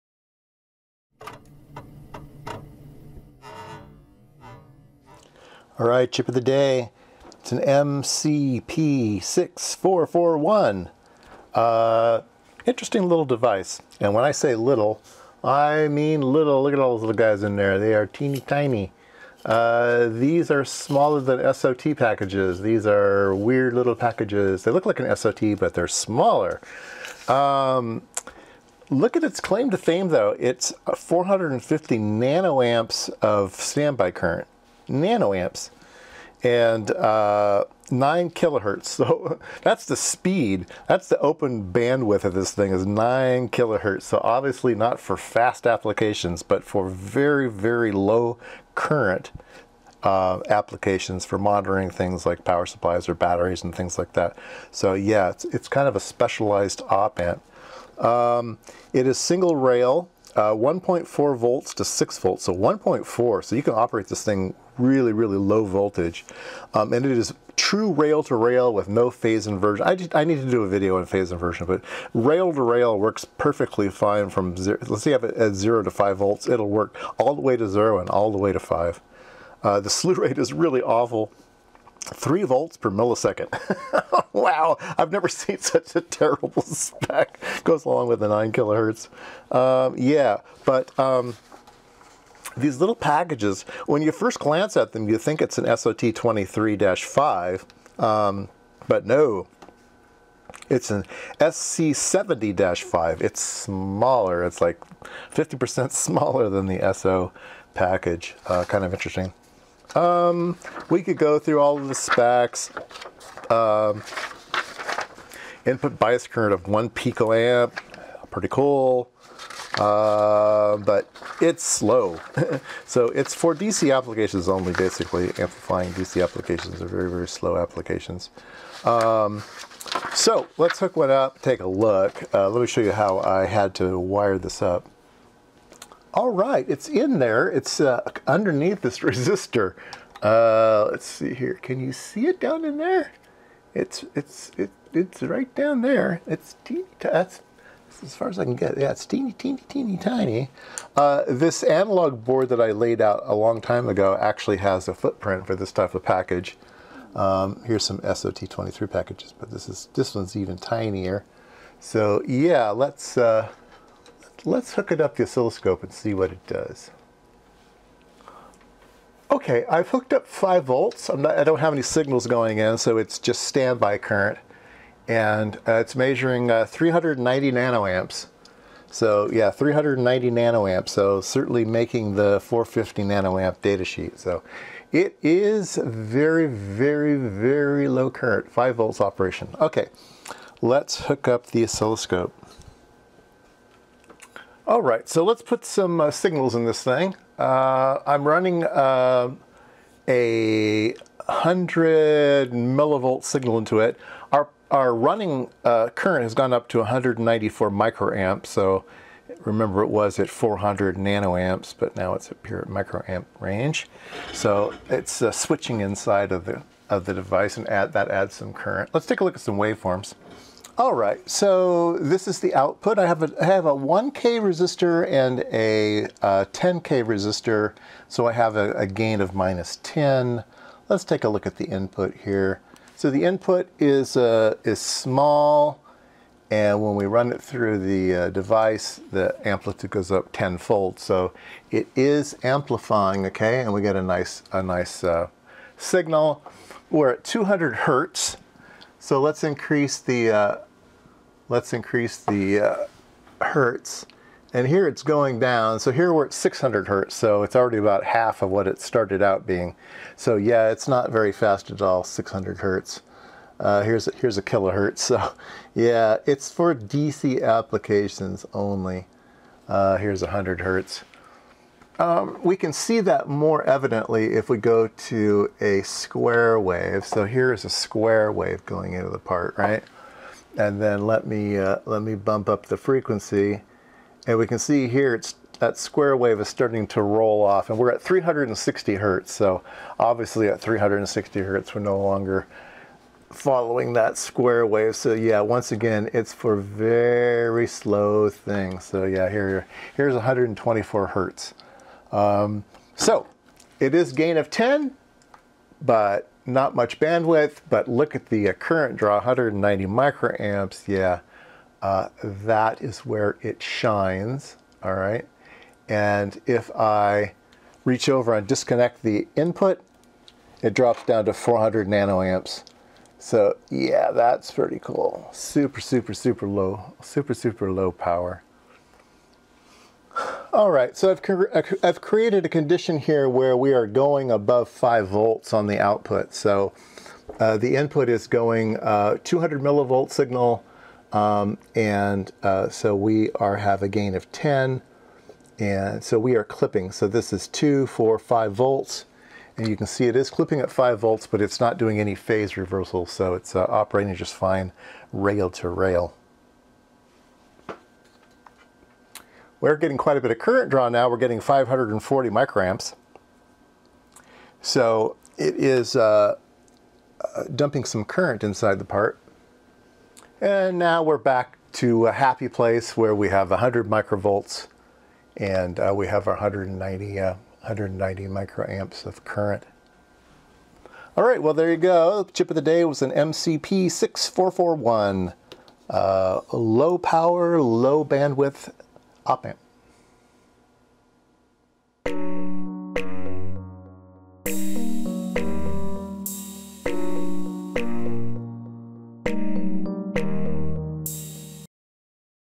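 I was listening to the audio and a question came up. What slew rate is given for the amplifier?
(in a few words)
3 volts per millisecond.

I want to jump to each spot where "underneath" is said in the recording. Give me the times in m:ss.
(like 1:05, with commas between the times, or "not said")
2:18.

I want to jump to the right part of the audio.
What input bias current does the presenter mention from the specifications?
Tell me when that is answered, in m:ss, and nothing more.
1:56.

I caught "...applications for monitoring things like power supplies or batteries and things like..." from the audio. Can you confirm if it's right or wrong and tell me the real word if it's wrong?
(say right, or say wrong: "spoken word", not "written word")
right.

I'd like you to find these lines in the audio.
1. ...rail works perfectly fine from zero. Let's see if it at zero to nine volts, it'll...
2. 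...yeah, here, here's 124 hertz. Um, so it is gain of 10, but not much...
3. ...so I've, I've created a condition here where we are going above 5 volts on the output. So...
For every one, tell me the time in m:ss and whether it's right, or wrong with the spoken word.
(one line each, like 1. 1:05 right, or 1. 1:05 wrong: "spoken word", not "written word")
1. 1:12 wrong: "five", not "nine"
2. 4:59 right
3. 5:30 right.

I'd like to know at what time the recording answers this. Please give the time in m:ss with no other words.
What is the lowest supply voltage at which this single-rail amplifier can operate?
1:00.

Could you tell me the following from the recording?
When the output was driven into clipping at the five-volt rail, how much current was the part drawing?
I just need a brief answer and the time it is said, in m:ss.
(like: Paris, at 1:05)
540 microamps, at 6:01.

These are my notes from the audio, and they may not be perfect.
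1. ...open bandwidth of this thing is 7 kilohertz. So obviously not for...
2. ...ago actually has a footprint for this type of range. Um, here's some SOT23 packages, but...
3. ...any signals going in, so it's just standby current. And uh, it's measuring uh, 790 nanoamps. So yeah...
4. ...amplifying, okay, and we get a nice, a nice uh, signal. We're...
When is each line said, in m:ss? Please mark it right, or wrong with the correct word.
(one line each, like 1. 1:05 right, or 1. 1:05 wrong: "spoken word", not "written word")
1. 0:41 wrong: "9", not "7"
2. 2:33 wrong: "package", not "range"
3. 2:51 wrong: "390", not "790"
4. 4:02 right.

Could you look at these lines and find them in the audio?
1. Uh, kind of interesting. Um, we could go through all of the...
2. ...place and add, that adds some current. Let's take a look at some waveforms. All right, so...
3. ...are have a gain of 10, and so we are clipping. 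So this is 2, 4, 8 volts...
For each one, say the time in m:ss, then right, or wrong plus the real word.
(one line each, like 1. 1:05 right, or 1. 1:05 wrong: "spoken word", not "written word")
1. 1:48 right
2. 3:37 wrong: "device", not "place"
3. 5:43 wrong: "5", not "8".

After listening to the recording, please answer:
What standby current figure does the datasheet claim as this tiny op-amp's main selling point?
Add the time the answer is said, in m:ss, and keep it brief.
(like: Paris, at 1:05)
450 nanoamps, at 0:30.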